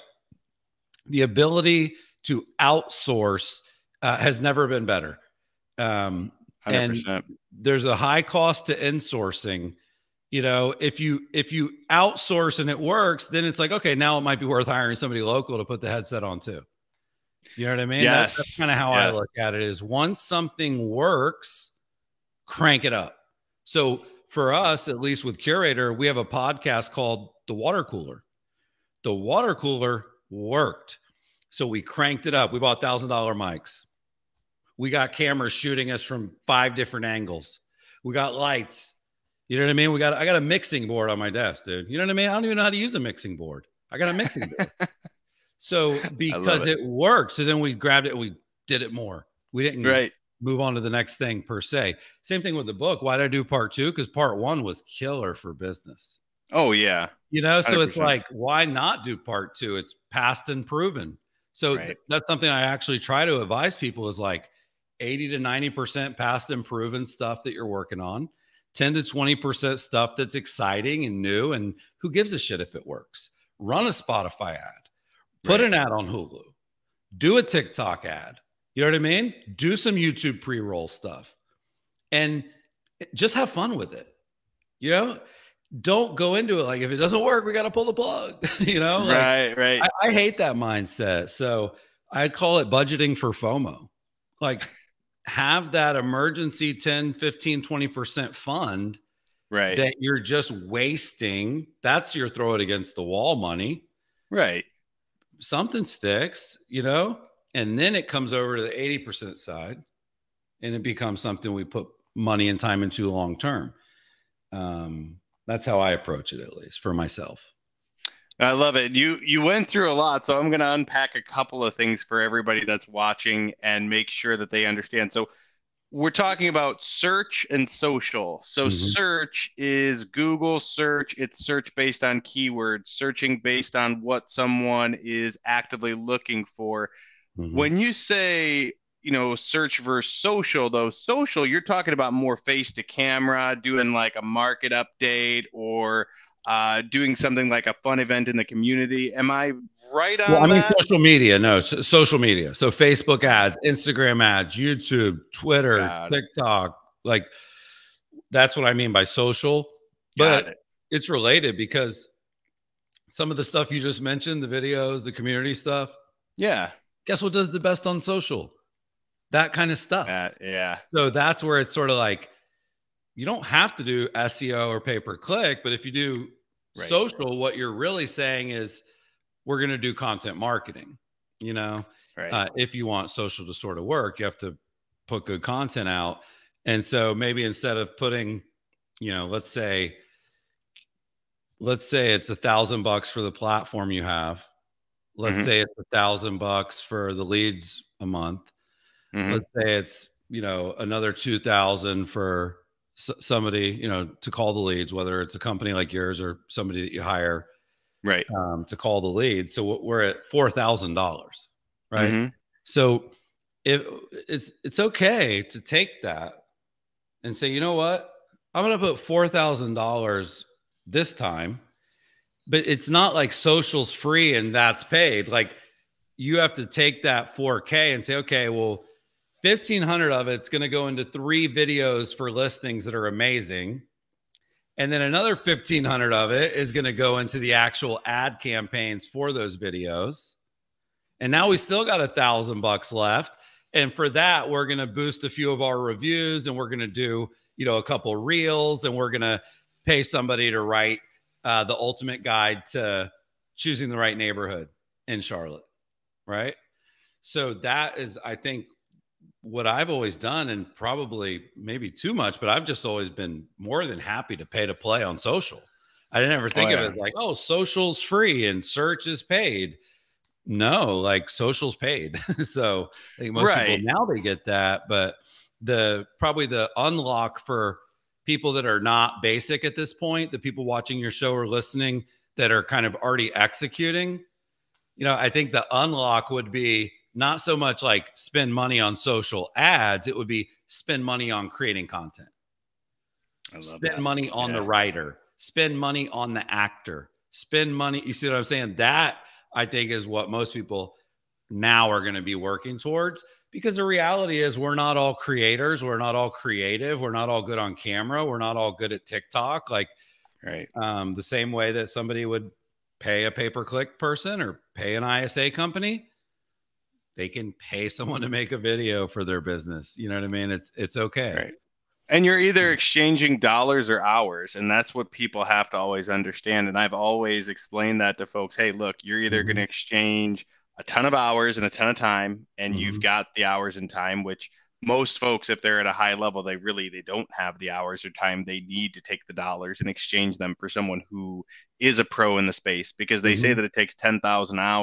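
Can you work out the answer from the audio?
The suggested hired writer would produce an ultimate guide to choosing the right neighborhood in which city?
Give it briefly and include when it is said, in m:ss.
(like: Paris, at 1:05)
Charlotte, at 4:15.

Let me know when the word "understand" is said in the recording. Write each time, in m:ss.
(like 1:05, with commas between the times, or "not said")
2:04, 5:26.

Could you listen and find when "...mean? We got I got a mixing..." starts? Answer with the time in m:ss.
0:39.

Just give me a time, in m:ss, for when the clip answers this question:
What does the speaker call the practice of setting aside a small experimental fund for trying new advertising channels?
1:32.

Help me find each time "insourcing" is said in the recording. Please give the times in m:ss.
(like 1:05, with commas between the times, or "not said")
0:08.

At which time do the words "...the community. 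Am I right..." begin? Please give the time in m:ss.
2:28.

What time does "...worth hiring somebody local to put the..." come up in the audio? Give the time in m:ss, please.
0:14.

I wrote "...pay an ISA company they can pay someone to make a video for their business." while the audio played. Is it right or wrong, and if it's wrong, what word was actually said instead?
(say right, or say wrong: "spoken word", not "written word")
right.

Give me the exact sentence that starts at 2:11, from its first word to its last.
It's search based on keywords, searching based on what someone is actively looking for.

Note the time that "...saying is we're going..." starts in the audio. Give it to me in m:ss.
2:58.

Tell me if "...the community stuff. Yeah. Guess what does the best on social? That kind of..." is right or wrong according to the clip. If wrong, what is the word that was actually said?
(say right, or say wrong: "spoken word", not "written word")
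right.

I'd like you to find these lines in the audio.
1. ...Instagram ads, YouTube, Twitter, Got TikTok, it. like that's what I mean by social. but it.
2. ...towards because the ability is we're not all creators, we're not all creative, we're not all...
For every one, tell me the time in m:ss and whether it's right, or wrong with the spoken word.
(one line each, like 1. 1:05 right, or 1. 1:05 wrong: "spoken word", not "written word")
1. 2:33 right
2. 5:02 wrong: "reality", not "ability".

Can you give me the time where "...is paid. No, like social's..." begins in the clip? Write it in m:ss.
4:29.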